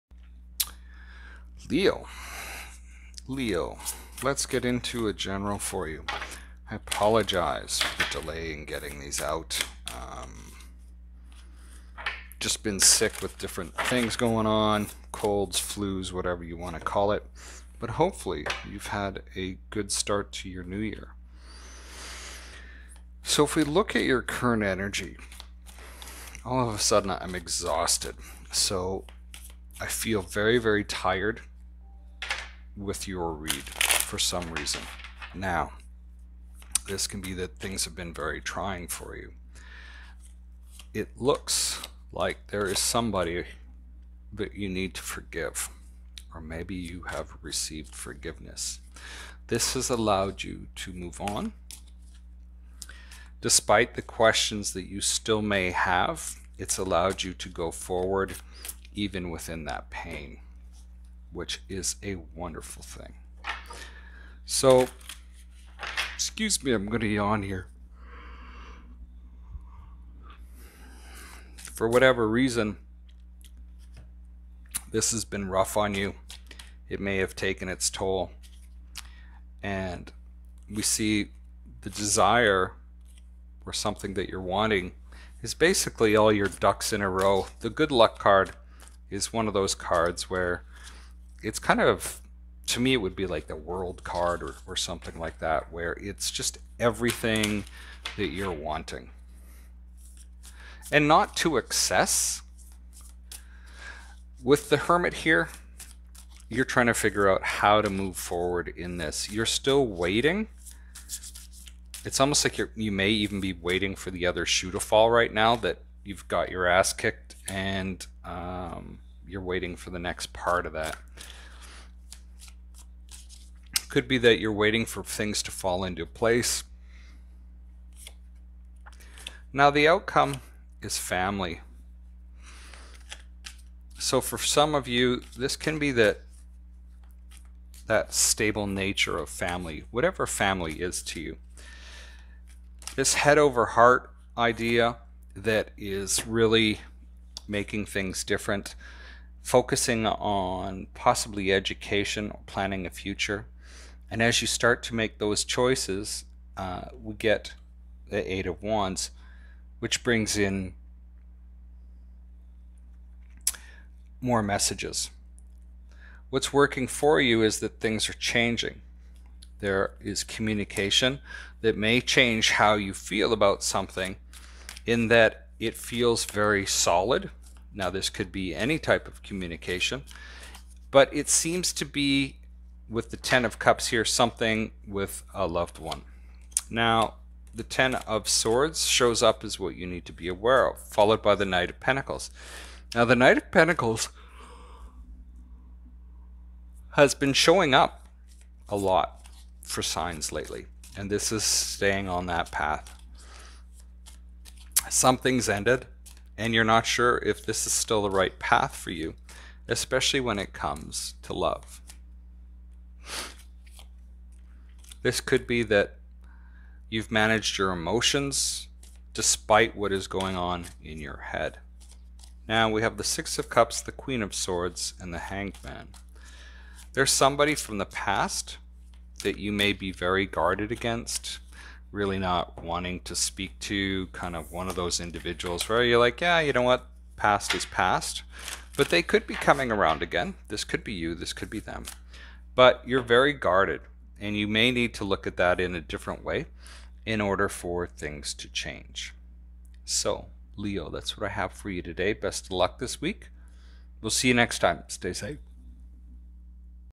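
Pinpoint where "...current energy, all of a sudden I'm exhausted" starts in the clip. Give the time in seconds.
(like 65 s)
24 s.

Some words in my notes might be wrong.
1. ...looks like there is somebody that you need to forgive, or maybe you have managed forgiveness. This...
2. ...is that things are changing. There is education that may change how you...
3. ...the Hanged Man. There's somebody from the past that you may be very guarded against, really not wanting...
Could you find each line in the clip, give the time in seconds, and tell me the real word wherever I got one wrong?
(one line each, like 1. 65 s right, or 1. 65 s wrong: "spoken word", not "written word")
1. 41 s wrong: "received", not "managed"
2. 167 s wrong: "communication", not "education"
3. 225 s right.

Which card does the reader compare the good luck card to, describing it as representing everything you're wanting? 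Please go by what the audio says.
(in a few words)
The World.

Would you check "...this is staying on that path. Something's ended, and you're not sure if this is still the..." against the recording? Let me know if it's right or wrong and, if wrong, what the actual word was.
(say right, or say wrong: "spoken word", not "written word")
right.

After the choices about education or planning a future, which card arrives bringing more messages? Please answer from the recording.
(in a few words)
Eight of Wands.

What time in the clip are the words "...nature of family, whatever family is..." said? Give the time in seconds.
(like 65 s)
138 s.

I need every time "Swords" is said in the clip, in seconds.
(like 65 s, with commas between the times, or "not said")
188 s, 224 s.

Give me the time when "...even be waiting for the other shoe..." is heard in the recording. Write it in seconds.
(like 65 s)
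113 s.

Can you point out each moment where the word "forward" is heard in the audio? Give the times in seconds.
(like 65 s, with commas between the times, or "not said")
57 s, 108 s.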